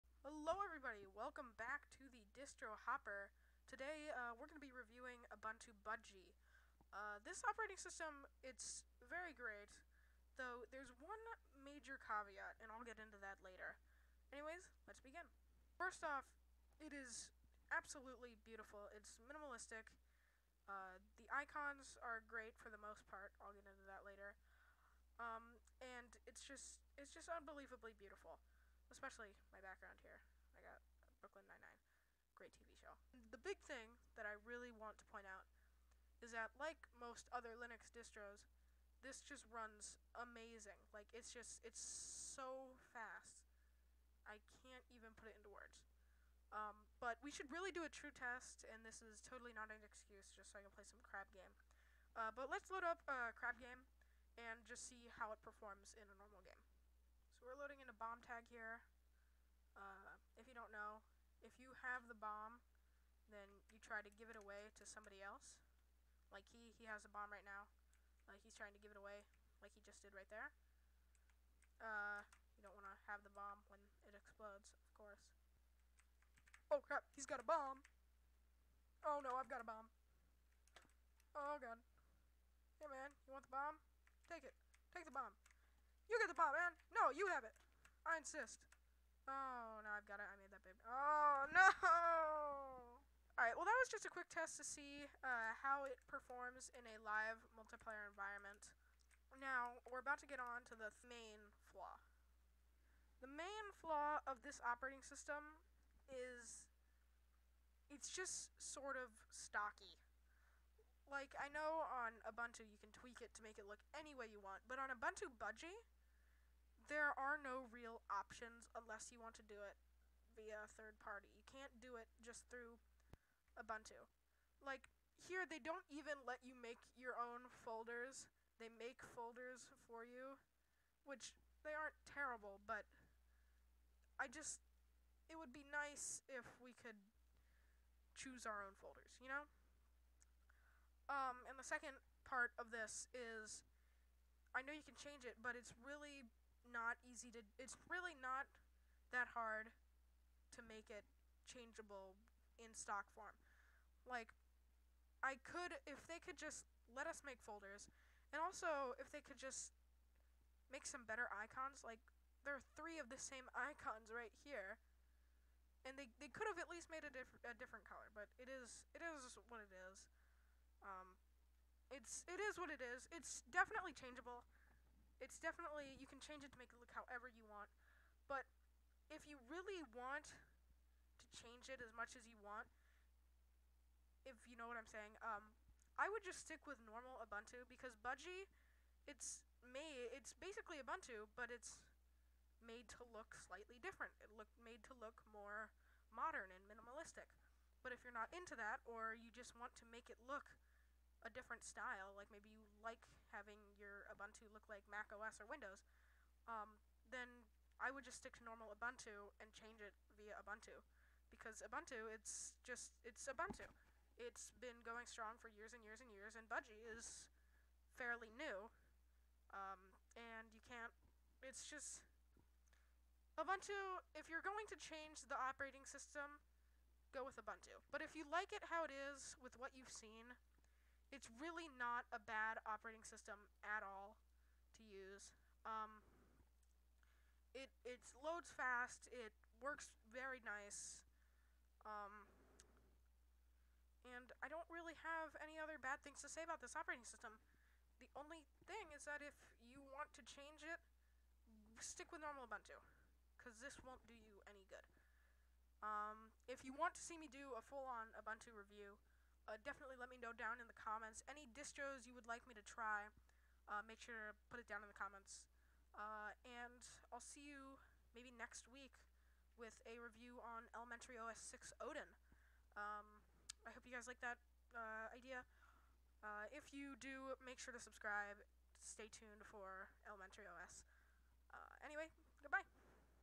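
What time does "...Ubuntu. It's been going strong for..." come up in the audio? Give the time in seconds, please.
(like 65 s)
213 s.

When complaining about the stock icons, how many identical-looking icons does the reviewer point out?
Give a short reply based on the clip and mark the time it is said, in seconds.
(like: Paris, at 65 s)
3, at 162 s.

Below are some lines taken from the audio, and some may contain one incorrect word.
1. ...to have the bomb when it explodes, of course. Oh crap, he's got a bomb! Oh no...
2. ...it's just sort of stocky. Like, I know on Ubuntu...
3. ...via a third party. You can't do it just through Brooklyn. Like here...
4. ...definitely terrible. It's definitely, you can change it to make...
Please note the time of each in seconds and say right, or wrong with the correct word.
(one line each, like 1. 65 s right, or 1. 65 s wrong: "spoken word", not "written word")
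1. 72 s right
2. 107 s right
3. 120 s wrong: "Ubuntu", not "Brooklyn"
4. 173 s wrong: "changeable", not "terrible".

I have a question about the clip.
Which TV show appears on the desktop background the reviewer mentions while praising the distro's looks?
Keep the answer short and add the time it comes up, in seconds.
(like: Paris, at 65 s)
Brooklyn Nine-Nine, at 31 s.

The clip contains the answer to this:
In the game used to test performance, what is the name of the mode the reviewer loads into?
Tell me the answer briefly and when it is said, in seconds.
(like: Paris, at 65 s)
bomb tag, at 57 s.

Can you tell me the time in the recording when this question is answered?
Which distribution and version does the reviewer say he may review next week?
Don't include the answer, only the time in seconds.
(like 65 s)
270 s.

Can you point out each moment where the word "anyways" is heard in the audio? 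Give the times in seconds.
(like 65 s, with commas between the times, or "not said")
14 s, 281 s.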